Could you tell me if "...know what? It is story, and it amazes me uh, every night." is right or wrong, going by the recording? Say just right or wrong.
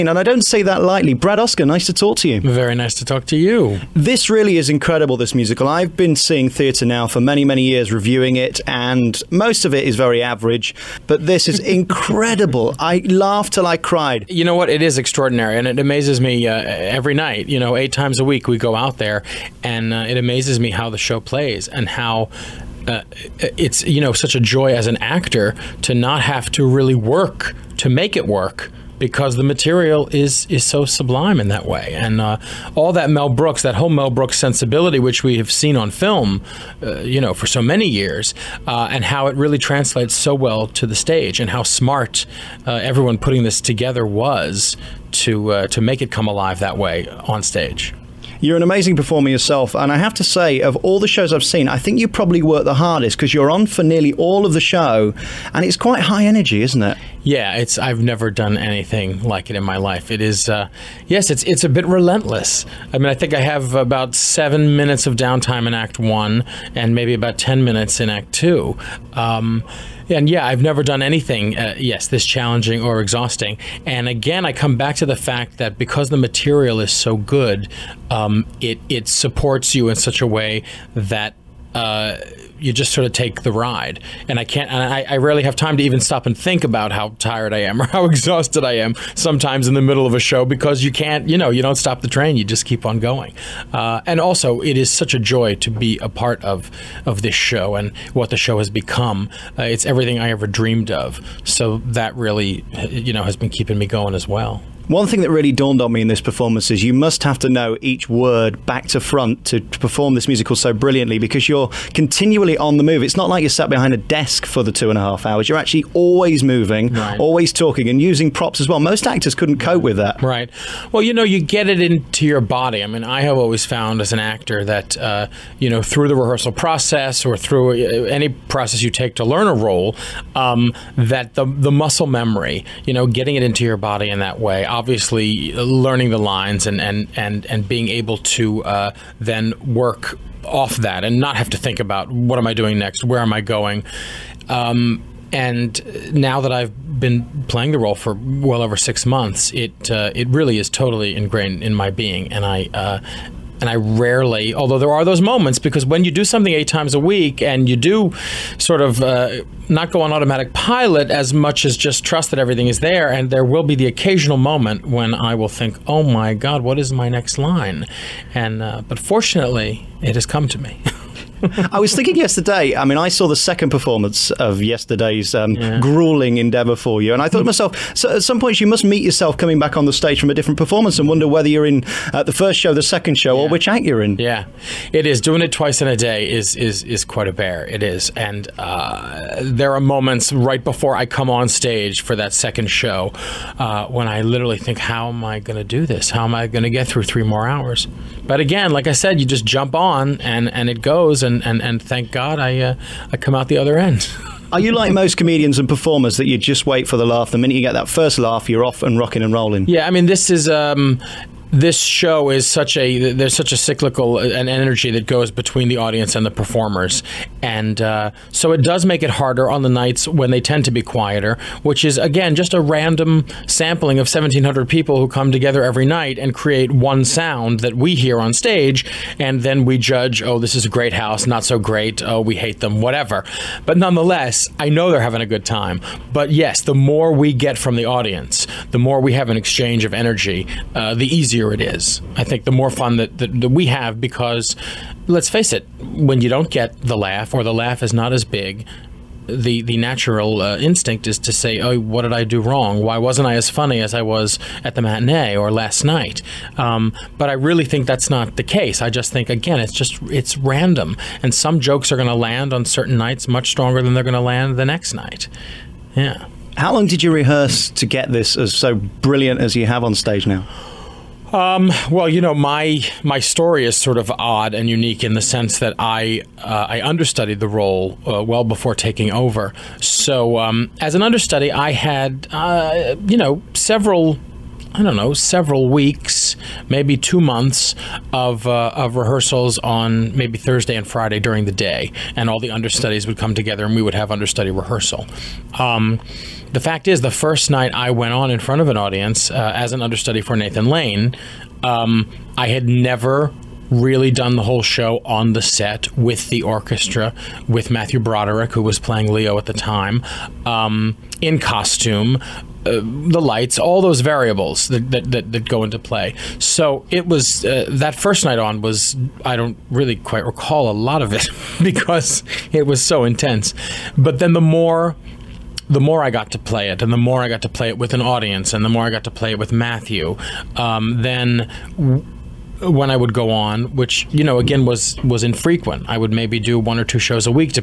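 wrong.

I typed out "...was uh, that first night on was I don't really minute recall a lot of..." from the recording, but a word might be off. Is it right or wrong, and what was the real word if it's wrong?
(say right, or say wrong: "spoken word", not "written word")
wrong: "quite", not "minute".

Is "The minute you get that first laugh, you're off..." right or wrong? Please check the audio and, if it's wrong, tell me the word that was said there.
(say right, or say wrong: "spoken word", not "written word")
right.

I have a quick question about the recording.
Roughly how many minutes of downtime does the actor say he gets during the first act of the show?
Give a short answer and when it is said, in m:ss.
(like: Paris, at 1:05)
7, at 1:04.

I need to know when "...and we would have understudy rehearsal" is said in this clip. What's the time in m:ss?
4:53.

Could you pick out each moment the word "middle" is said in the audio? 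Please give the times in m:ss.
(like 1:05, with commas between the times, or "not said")
1:29.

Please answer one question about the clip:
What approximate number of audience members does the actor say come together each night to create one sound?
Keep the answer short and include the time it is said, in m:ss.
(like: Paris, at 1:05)
1,700, at 3:44.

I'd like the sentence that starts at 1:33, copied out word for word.
Uh, and also, it is such a joy to be a part of, of this show and what the show has become.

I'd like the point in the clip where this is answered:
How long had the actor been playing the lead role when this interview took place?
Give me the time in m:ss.
2:28.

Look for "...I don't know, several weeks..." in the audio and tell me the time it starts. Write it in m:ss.
4:44.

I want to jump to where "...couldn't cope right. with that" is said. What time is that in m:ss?
1:59.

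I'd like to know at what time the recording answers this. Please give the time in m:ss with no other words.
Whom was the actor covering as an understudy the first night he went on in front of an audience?
5:00.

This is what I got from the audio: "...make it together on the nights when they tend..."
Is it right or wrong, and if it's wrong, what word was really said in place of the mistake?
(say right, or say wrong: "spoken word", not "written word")
wrong: "harder", not "together".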